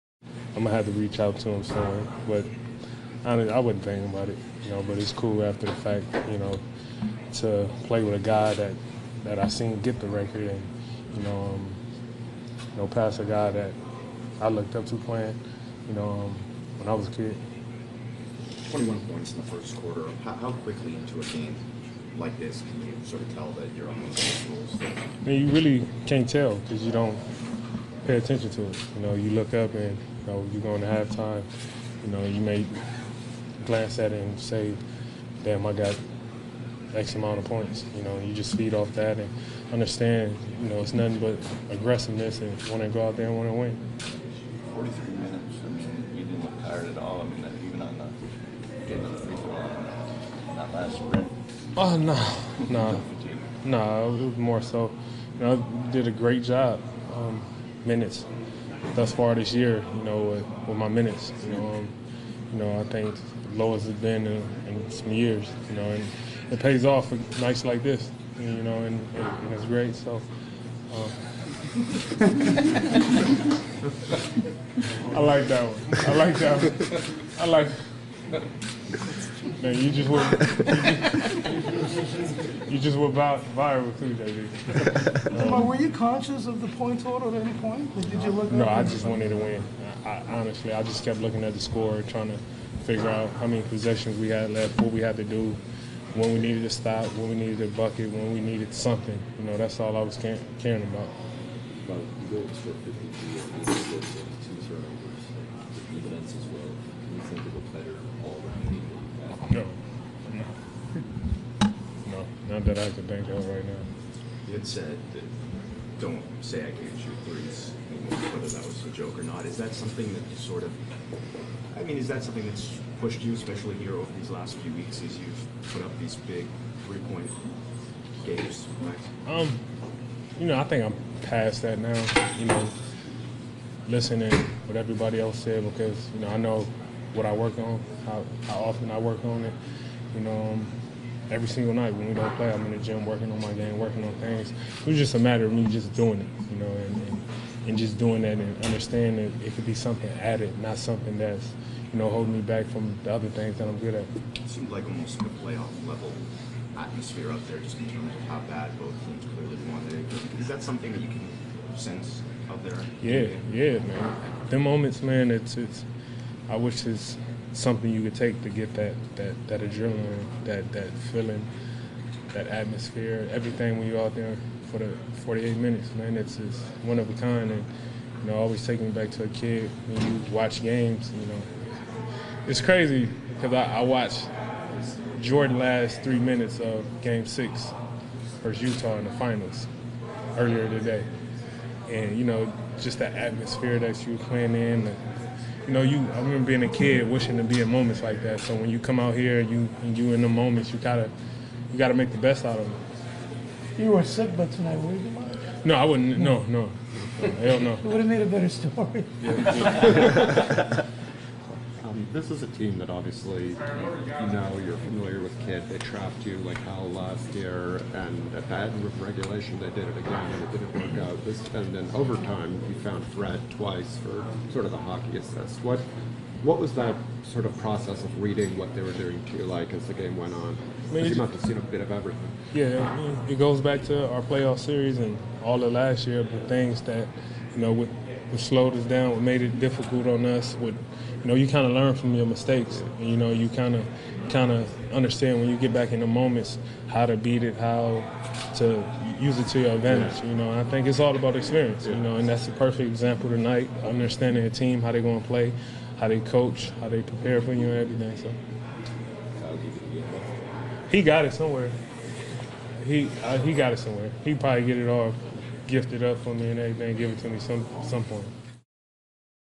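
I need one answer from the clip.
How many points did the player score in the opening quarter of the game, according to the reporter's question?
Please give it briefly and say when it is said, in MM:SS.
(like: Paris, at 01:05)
21, at 00:18.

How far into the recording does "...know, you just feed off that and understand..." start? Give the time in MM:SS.
00:38.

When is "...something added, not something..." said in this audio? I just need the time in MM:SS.
02:29.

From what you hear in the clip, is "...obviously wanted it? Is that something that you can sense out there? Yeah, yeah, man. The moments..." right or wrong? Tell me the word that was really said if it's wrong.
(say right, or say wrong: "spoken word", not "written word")
wrong: "clearly", not "obviously".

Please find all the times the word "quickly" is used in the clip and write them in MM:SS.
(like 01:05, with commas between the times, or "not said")
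00:20.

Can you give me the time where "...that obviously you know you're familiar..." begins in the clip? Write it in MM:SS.
03:32.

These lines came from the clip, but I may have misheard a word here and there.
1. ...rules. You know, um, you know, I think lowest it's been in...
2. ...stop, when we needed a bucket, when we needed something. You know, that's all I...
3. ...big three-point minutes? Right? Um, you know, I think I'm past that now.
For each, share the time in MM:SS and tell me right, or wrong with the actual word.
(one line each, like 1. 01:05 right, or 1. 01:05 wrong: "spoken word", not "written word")
1. 01:00 wrong: "minutes", not "rules"
2. 01:36 right
3. 02:06 wrong: "games", not "minutes".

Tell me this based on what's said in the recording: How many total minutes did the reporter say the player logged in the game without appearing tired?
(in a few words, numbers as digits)
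43.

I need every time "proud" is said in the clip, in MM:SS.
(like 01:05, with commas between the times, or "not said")
not said.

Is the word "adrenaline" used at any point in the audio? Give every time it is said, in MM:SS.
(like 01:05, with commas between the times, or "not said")
02:49.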